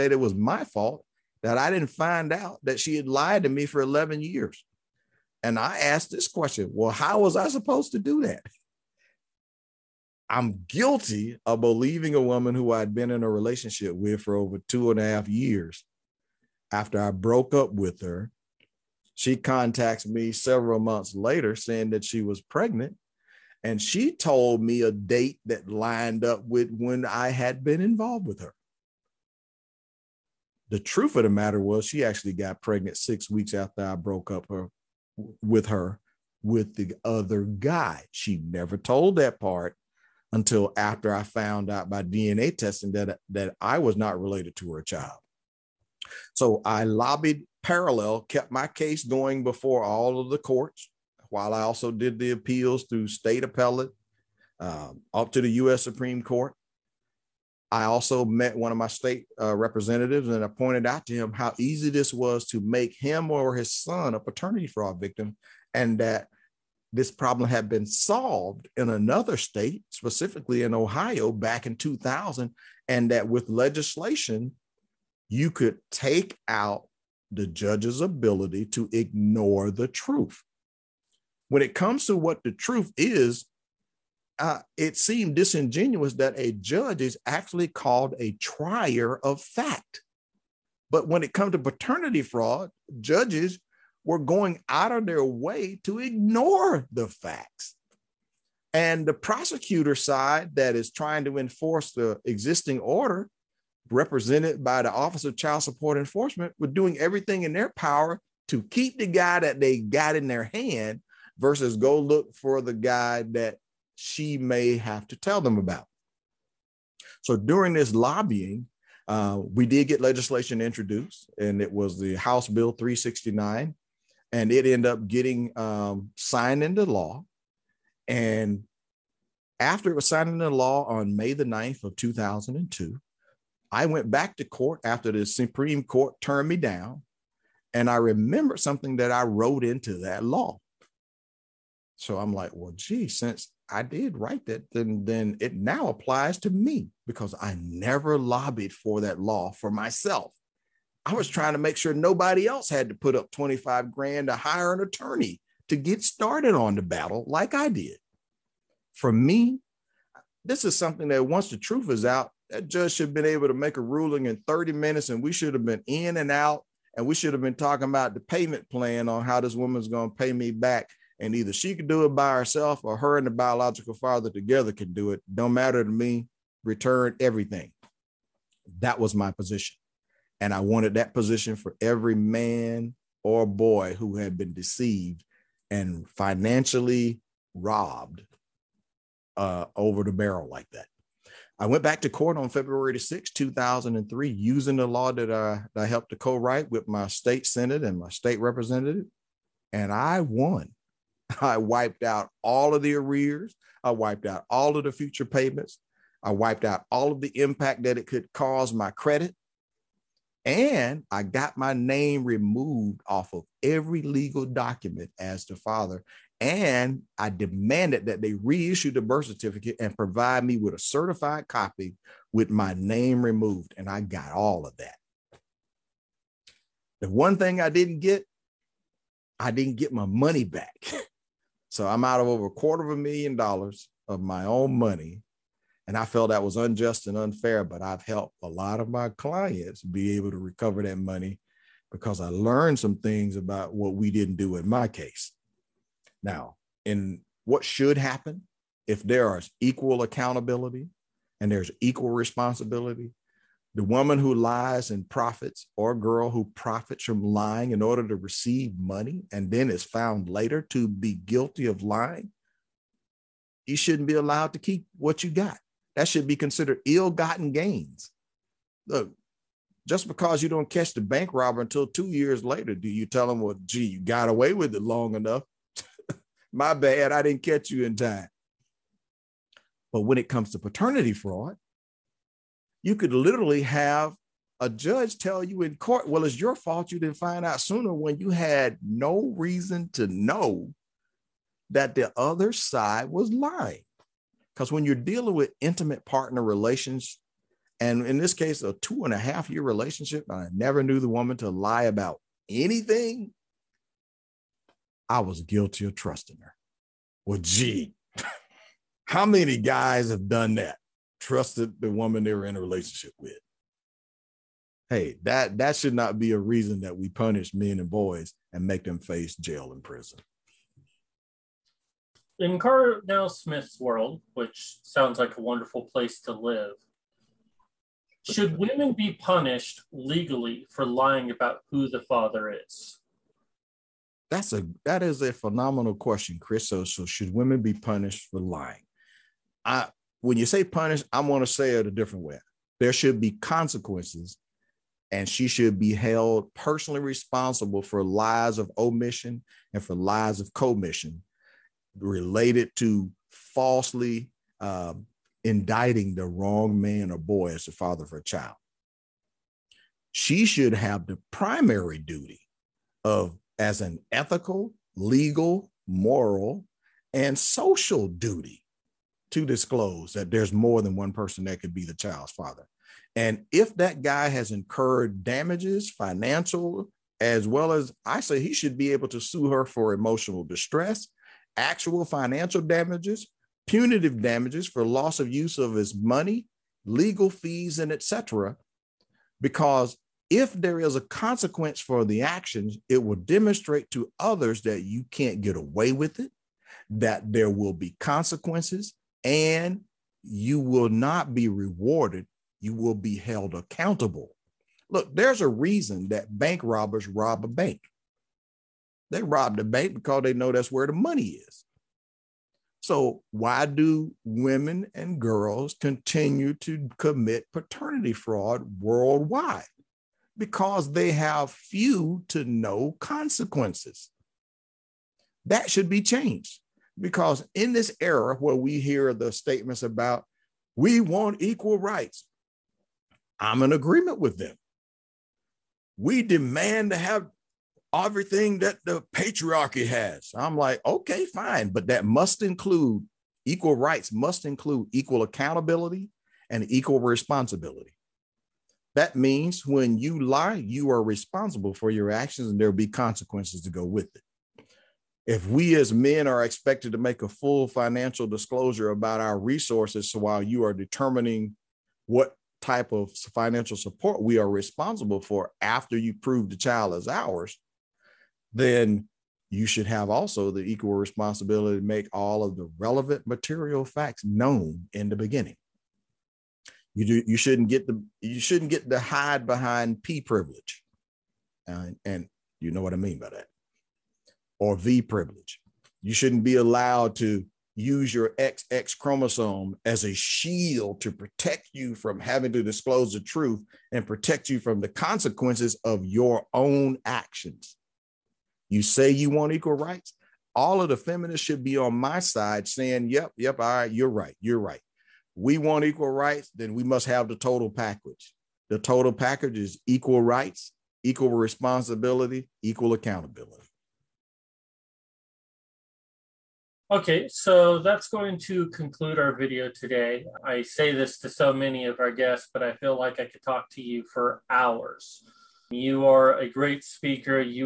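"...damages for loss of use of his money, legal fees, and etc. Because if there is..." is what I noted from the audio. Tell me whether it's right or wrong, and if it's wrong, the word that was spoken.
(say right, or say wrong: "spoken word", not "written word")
right.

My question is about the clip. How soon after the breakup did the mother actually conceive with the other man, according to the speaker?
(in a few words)
6 weeks.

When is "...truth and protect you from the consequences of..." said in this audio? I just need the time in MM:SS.
08:13.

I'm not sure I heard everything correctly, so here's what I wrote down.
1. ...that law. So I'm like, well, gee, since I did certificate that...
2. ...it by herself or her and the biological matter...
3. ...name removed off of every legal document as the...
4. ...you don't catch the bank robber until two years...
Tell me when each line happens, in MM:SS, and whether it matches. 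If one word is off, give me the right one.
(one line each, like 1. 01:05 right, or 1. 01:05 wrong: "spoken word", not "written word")
1. 02:20 wrong: "write", not "certificate"
2. 02:52 wrong: "father", not "matter"
3. 03:31 right
4. 04:30 right.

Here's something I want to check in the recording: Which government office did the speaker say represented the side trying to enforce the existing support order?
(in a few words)
Office of Child Support Enforcement.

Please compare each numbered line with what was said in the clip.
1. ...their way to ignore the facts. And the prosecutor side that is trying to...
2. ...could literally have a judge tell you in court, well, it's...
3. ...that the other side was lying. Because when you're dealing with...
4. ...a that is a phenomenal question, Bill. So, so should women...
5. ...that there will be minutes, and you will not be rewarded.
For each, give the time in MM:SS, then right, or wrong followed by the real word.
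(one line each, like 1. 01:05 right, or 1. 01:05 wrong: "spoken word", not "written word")
1. 01:35 right
2. 04:42 right
3. 04:51 right
4. 05:34 wrong: "Chris", not "Bill"
5. 06:36 wrong: "consequences", not "minutes".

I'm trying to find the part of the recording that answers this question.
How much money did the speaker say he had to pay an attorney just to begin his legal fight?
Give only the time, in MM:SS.
02:33.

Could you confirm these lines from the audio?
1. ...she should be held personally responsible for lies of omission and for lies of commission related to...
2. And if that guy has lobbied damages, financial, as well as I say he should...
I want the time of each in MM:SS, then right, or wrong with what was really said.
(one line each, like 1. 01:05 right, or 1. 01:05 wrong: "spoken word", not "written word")
1. 05:45 right
2. 06:13 wrong: "incurred", not "lobbied".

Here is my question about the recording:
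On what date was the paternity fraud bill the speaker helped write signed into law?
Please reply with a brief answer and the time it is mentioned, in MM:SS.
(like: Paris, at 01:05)
May 9, 2002, at 02:11.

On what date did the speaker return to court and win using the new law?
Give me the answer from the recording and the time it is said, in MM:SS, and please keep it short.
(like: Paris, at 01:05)
February 6, 2003, at 03:12.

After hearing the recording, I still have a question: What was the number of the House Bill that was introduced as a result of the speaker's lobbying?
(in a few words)
369.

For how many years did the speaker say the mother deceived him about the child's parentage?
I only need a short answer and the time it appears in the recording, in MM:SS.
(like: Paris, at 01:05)
11 years, at 00:03.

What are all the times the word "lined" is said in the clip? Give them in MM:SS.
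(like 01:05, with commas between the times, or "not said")
00:25.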